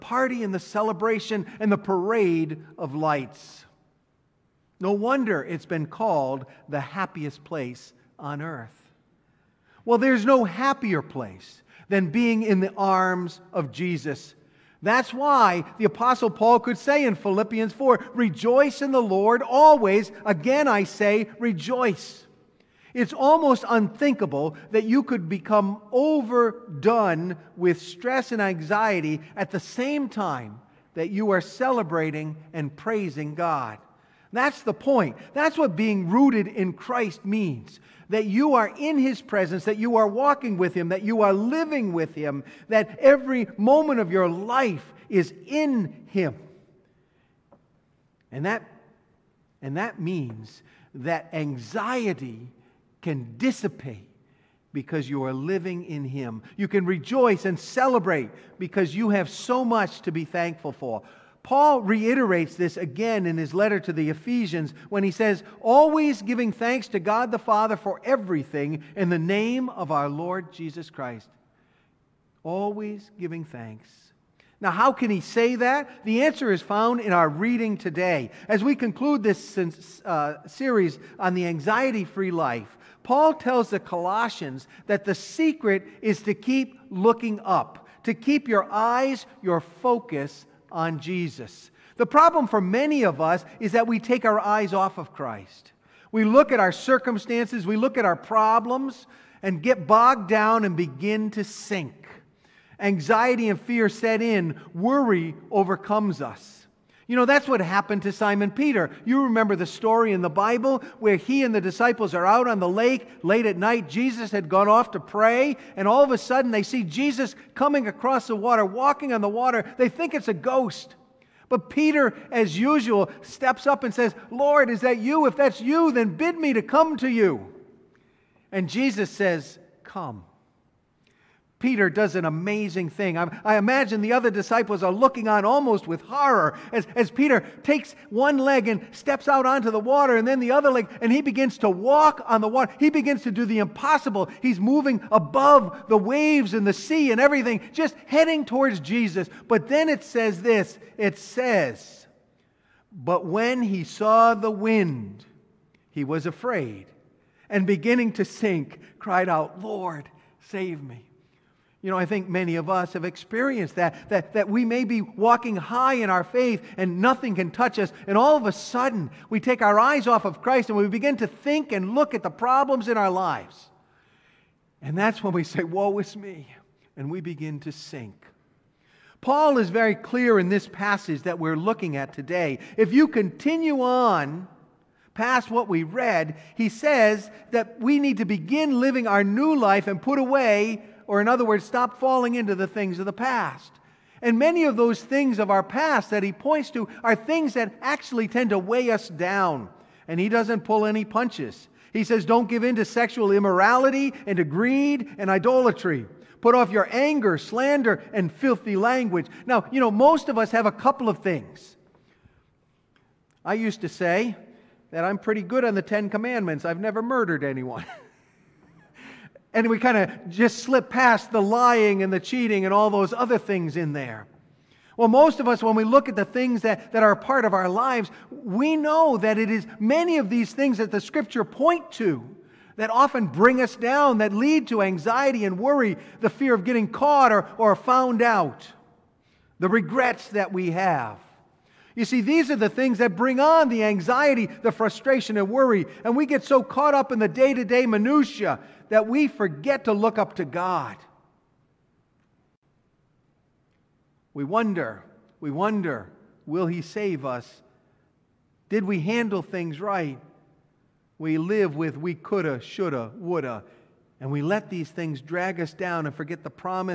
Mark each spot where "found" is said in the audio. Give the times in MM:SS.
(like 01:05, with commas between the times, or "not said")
01:16, 03:57.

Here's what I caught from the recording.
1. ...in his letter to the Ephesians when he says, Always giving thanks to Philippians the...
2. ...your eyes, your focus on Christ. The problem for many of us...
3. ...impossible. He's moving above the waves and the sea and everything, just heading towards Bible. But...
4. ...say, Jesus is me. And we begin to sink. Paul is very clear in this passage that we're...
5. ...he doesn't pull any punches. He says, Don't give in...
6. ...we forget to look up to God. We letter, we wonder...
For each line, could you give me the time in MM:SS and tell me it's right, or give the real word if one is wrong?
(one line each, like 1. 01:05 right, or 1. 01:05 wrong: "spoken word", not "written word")
1. 01:03 wrong: "God", not "Philippians"
2. 01:28 wrong: "Jesus", not "Christ"
3. 02:23 wrong: "Jesus", not "Bible"
4. 02:55 wrong: "Woe", not "Jesus"
5. 03:20 right
6. 04:09 wrong: "wonder", not "letter".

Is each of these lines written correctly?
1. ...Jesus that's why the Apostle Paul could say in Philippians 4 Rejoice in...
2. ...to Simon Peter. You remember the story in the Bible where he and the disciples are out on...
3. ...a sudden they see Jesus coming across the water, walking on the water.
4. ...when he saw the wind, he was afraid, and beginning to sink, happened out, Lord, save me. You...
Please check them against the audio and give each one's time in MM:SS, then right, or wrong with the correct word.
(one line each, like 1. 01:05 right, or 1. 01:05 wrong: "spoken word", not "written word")
1. 00:13 right
2. 01:48 right
3. 01:56 right
4. 02:33 wrong: "cried", not "happened".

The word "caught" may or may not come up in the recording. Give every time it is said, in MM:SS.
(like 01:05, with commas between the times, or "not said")
03:56, 04:06.